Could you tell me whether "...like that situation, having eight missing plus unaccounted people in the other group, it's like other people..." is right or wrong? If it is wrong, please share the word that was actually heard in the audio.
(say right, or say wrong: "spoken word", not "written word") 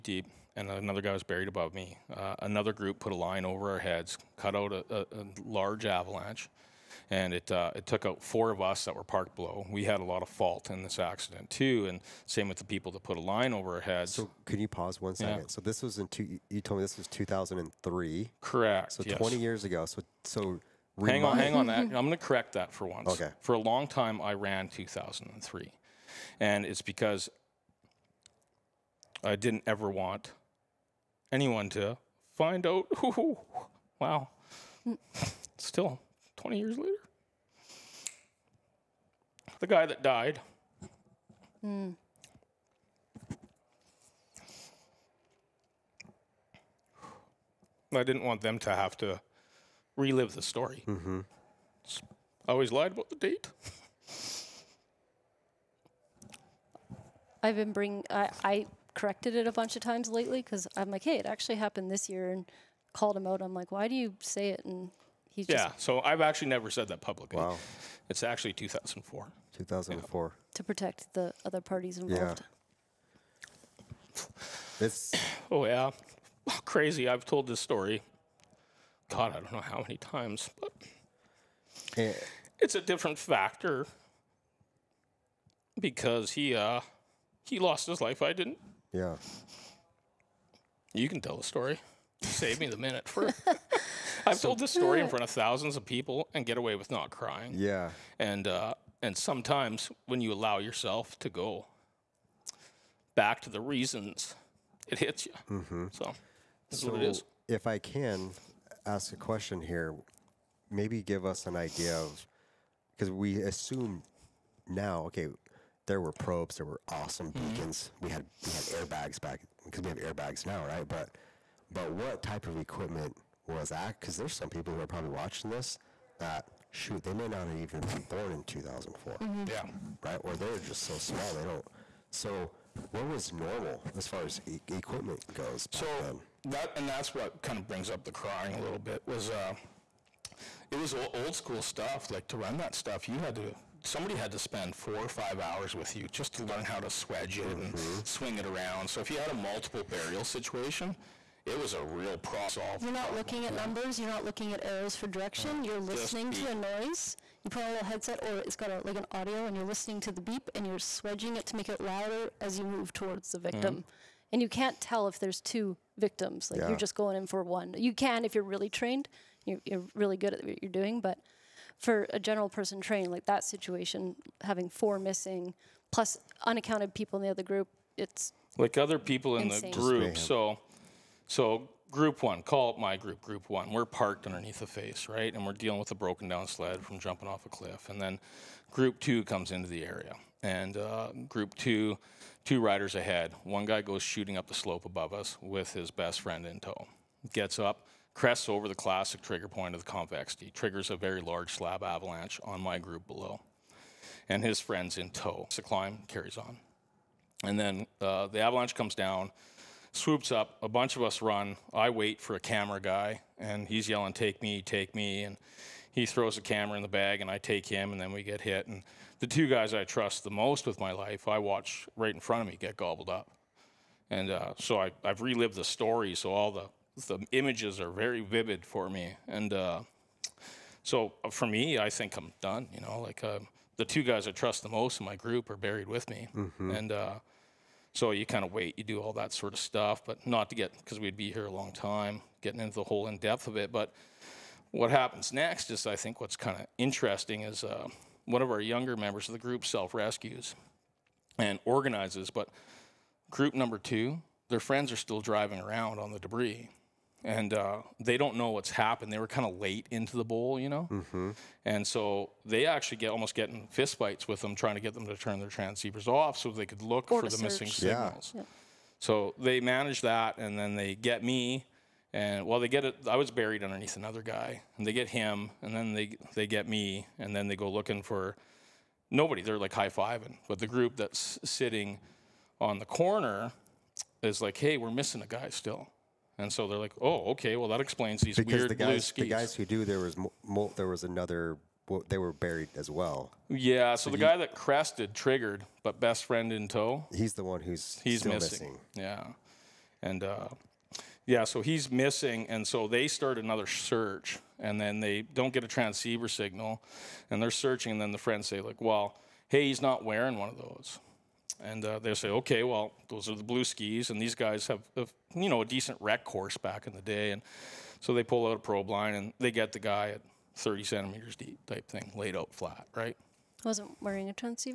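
wrong: "four", not "eight".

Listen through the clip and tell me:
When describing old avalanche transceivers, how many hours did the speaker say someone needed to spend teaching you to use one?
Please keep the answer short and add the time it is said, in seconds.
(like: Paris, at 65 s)
4 or 5 hours, at 144 s.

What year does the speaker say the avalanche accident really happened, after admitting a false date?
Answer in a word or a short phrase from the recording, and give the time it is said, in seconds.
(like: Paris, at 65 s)
2004, at 68 s.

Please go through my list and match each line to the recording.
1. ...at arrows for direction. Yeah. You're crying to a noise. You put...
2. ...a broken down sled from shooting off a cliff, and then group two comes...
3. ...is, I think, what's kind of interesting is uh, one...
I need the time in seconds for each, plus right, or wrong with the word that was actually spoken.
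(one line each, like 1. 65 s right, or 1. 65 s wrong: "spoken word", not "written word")
1. 154 s wrong: "listening", not "crying"
2. 185 s wrong: "jumping", not "shooting"
3. 245 s right.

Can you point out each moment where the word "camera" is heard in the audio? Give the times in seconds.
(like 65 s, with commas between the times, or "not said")
212 s, 216 s.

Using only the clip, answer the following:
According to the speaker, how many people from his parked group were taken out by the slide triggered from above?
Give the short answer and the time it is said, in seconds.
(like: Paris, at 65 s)
4, at 8 s.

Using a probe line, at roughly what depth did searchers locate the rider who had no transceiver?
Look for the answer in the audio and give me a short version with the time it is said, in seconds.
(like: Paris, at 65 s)
30 centimeters, at 320 s.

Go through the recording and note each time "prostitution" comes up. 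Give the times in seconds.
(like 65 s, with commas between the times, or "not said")
not said.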